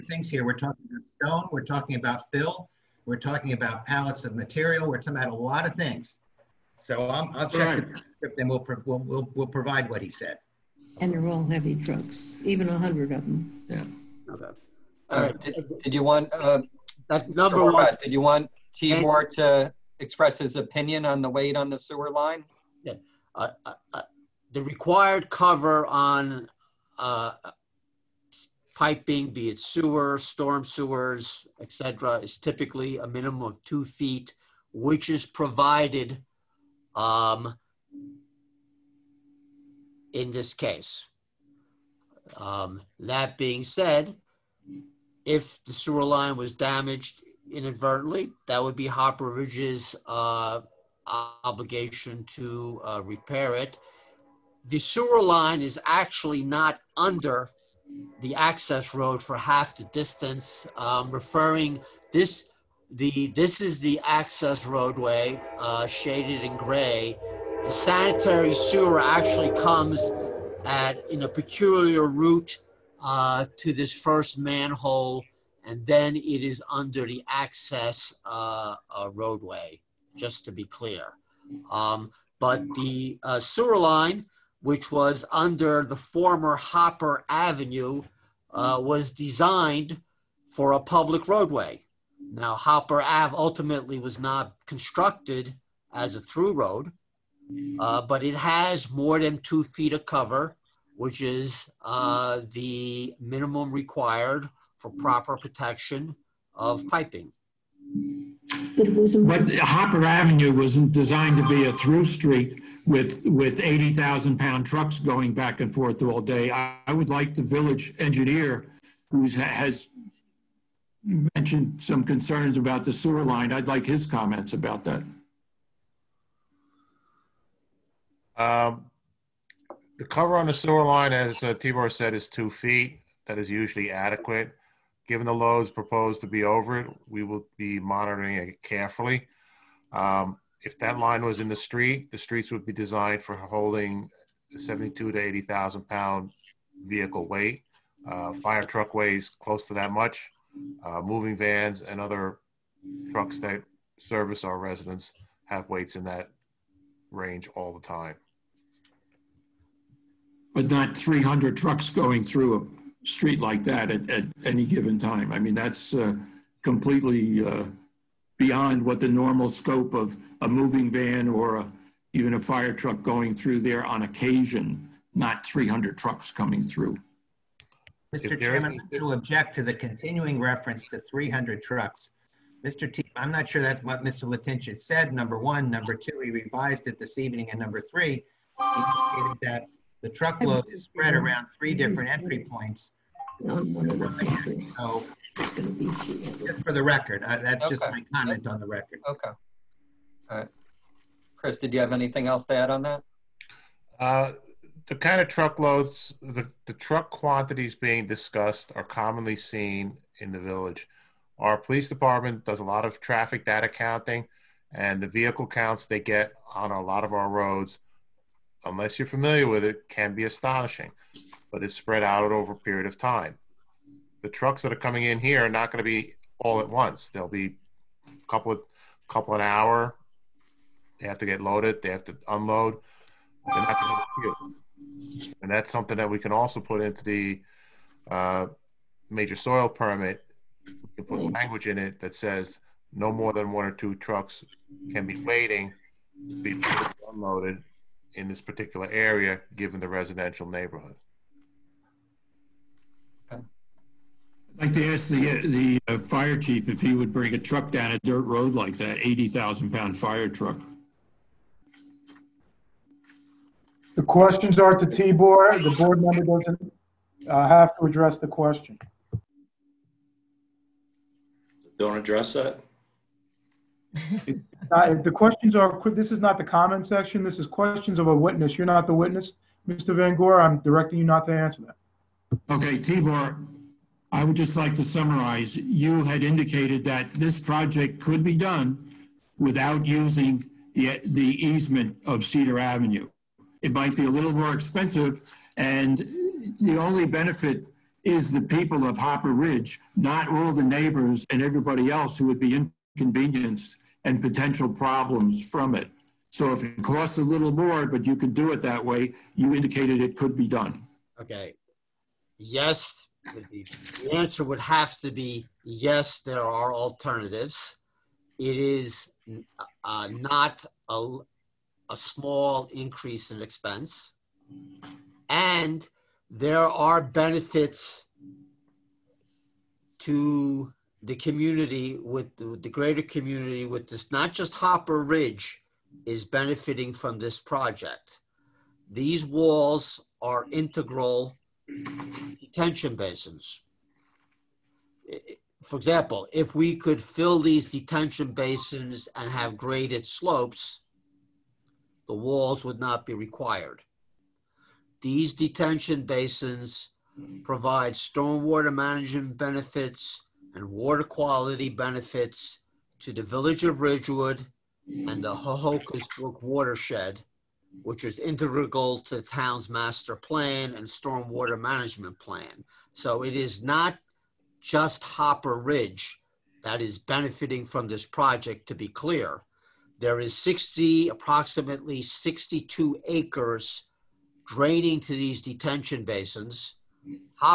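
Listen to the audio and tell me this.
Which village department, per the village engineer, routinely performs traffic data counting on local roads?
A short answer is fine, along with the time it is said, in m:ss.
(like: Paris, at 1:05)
Police department, at 3:31.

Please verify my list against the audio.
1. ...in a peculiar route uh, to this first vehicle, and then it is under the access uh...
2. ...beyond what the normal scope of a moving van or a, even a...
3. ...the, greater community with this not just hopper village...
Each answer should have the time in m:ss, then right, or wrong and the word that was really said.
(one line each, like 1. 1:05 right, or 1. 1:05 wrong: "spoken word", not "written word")
1. 1:11 wrong: "manhole", not "vehicle"
2. 2:48 right
3. 5:32 wrong: "ridge", not "village".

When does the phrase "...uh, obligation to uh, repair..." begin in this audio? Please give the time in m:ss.
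0:50.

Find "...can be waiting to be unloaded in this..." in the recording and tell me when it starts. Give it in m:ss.
4:04.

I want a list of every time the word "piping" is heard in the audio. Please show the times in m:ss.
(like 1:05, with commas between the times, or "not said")
0:28, 1:46.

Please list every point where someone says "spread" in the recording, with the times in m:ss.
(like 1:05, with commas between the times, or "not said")
3:10, 3:41.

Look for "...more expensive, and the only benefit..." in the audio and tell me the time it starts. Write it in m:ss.
4:54.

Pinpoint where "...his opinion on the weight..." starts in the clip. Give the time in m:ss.
0:20.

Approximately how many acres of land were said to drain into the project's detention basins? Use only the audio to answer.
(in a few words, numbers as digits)
62 acres.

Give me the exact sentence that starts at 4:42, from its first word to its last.
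Okay, Tibor, I would just like to summarize.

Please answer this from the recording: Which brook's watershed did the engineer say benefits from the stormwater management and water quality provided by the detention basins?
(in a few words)
Ho-Ho-Kus Brook.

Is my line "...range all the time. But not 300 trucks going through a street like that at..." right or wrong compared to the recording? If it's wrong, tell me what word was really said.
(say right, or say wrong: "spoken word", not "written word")
right.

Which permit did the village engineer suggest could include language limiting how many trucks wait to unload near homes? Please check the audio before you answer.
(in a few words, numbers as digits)
Major soil permit.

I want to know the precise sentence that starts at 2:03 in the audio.
I'd like his comments about that.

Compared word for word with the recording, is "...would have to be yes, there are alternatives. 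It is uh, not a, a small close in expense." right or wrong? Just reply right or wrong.
wrong.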